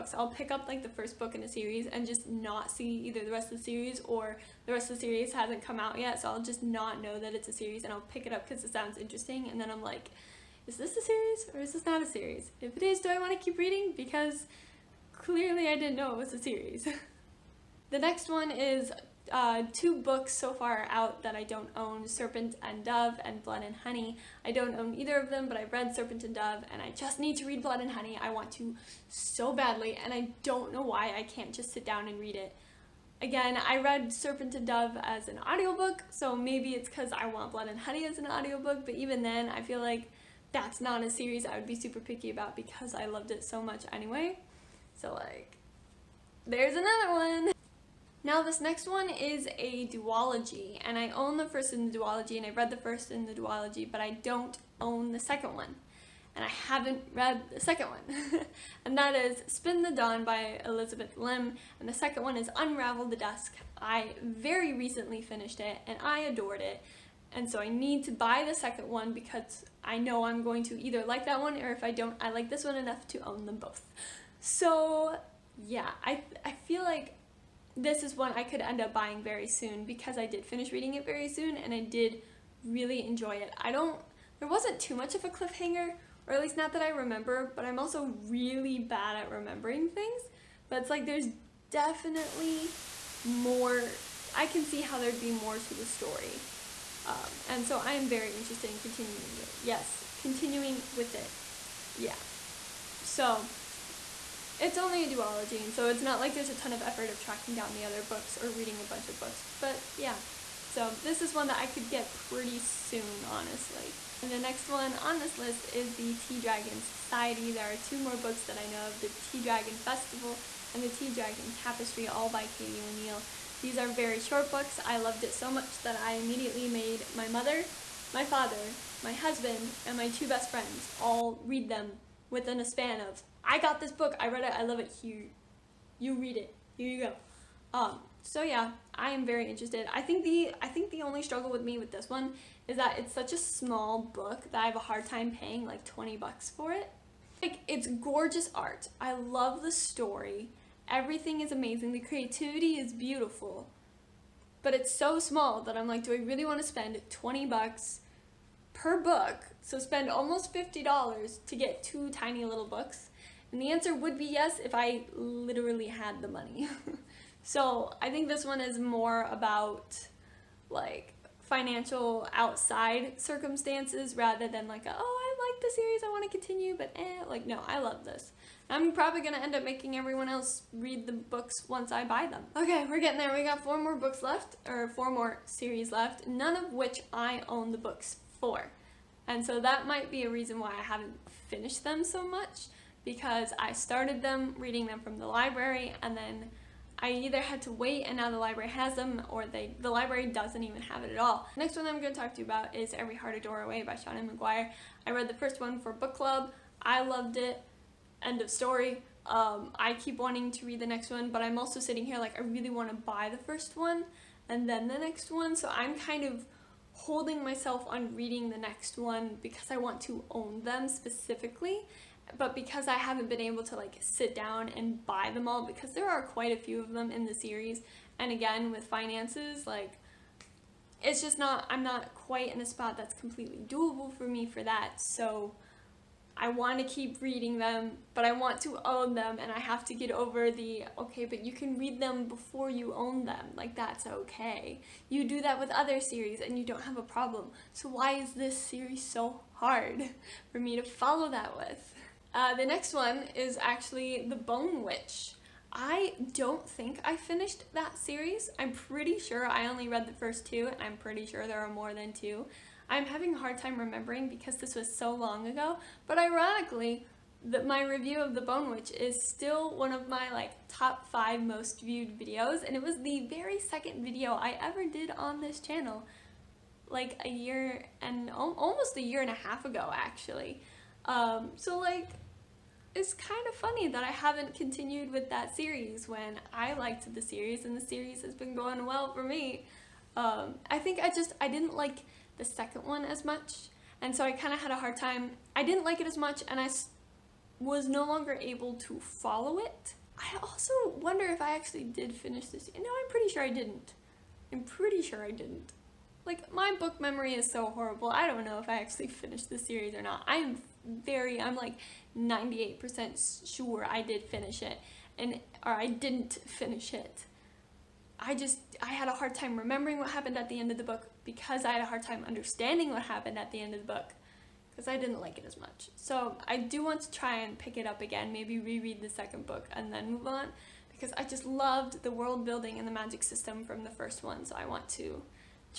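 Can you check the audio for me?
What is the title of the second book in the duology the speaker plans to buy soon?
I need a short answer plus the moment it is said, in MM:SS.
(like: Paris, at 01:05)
Unravel the Dusk, at 01:02.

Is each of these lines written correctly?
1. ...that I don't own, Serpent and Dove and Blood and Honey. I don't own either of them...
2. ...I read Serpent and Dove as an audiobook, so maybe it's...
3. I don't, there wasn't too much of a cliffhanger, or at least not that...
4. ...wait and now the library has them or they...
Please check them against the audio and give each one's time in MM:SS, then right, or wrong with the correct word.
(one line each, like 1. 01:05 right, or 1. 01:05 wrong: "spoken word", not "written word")
1. 00:21 right
2. 00:33 right
3. 01:23 right
4. 03:17 right.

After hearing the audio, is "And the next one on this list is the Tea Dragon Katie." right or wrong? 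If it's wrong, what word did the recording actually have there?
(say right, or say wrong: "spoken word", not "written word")
wrong: "Society", not "Katie".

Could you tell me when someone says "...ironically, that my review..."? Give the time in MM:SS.
04:26.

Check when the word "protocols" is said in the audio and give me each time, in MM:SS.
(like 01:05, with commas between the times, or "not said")
not said.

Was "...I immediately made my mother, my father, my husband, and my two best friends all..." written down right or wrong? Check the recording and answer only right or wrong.
right.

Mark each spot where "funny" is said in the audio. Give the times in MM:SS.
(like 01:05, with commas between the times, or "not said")
04:43.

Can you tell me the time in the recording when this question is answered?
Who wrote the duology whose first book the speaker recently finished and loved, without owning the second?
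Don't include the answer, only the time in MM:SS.
01:00.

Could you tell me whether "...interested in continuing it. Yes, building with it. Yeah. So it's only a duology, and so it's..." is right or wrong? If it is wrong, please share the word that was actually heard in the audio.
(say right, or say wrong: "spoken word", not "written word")
wrong: "continuing", not "building".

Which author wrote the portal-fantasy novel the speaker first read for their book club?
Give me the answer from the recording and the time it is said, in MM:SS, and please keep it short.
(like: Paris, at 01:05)
Seanan McGuire, at 03:23.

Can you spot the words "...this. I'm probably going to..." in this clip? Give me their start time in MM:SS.
02:58.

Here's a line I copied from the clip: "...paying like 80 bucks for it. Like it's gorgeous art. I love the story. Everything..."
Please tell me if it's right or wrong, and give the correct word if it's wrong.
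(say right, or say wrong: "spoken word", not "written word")
wrong: "20", not "80".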